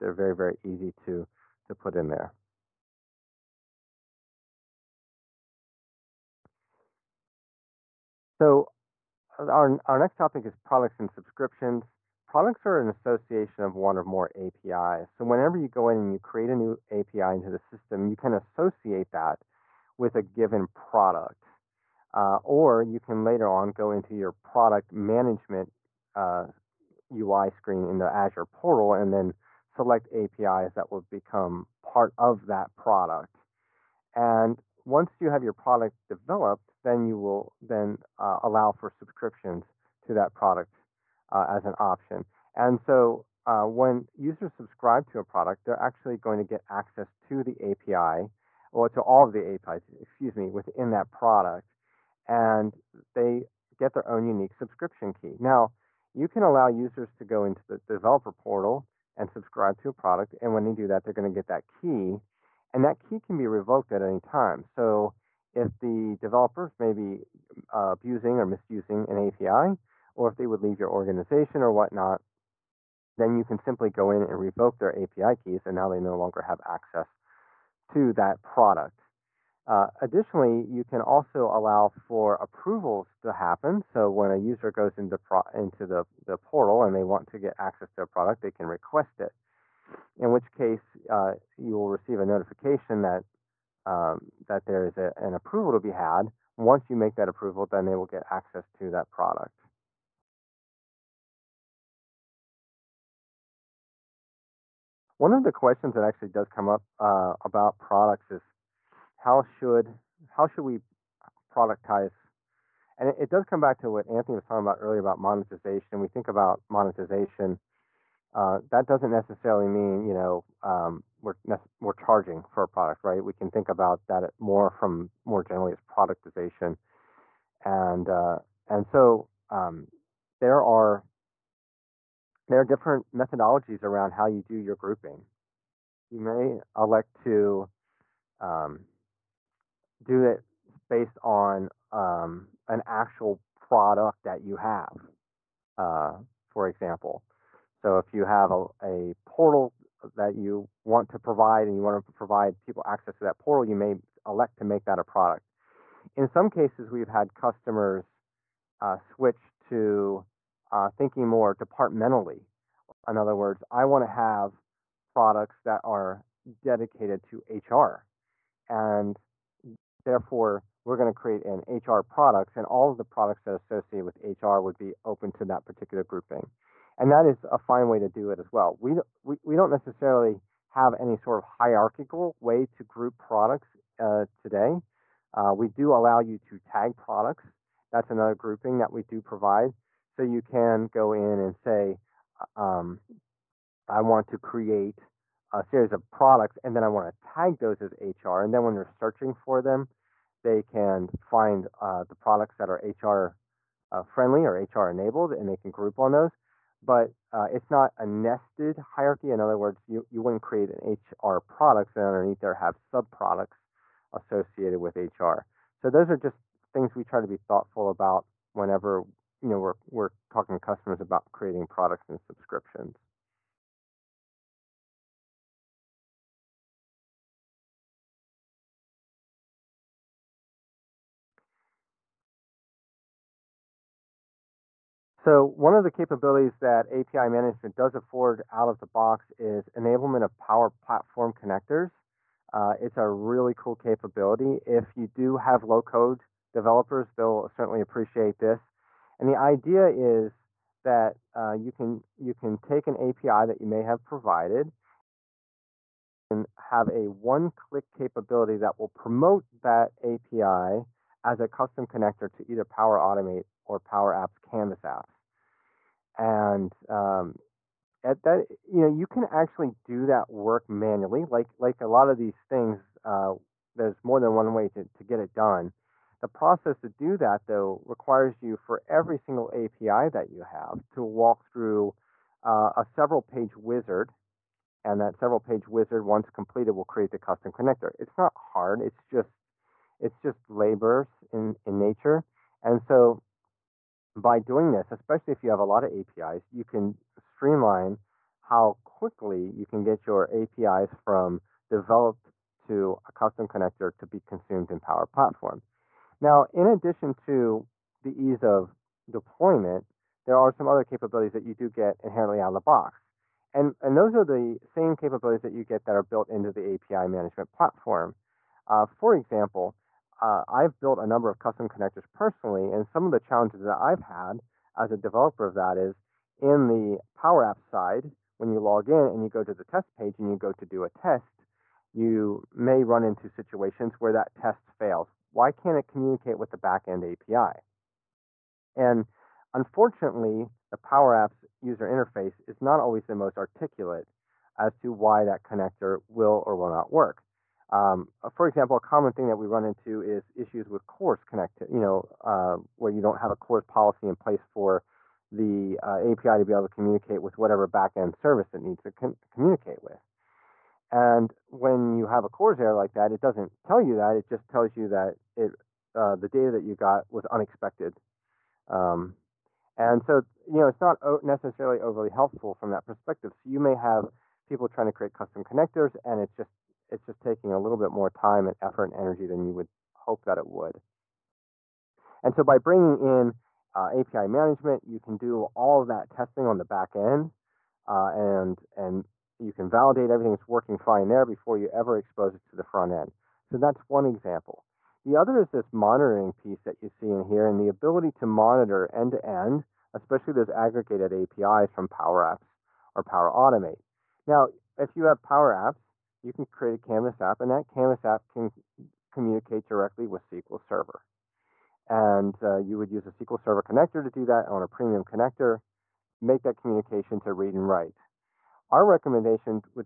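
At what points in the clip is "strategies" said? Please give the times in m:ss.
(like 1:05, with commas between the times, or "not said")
not said.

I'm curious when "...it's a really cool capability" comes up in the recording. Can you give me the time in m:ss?
4:02.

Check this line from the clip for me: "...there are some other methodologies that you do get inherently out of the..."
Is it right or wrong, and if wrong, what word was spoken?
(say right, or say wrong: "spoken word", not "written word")
wrong: "capabilities", not "methodologies".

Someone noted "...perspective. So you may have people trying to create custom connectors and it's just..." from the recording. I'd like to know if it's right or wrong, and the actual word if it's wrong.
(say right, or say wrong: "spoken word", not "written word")
right.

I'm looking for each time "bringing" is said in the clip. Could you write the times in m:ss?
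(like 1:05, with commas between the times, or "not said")
6:22.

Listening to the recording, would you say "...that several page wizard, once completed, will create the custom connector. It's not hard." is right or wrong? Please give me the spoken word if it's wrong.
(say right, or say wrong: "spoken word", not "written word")
right.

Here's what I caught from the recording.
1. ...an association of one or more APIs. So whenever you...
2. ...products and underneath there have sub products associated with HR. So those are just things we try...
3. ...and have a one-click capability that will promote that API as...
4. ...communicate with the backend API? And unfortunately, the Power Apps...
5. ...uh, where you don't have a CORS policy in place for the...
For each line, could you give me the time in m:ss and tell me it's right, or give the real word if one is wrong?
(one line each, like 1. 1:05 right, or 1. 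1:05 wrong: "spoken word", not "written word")
1. 0:12 right
2. 3:31 right
3. 4:16 right
4. 5:35 right
5. 5:52 right.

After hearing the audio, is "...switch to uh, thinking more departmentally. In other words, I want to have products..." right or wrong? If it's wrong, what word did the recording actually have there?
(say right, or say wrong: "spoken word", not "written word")
right.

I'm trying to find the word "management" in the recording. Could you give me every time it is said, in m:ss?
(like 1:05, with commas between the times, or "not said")
0:24, 3:57, 5:17, 6:24.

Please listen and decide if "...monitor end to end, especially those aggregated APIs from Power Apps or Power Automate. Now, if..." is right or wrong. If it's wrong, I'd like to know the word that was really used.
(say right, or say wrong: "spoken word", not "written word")
right.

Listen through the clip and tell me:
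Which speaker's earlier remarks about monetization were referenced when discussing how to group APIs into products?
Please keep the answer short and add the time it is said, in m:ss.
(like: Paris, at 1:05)
Anthony, at 1:54.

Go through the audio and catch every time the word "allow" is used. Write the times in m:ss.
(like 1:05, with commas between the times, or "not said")
0:38, 0:56, 1:21, 3:05.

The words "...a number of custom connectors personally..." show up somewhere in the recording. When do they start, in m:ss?
5:20.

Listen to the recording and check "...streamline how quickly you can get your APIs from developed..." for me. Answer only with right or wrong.
right.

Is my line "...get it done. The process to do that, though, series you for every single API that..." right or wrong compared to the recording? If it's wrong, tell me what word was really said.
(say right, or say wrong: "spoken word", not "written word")
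wrong: "requires", not "series".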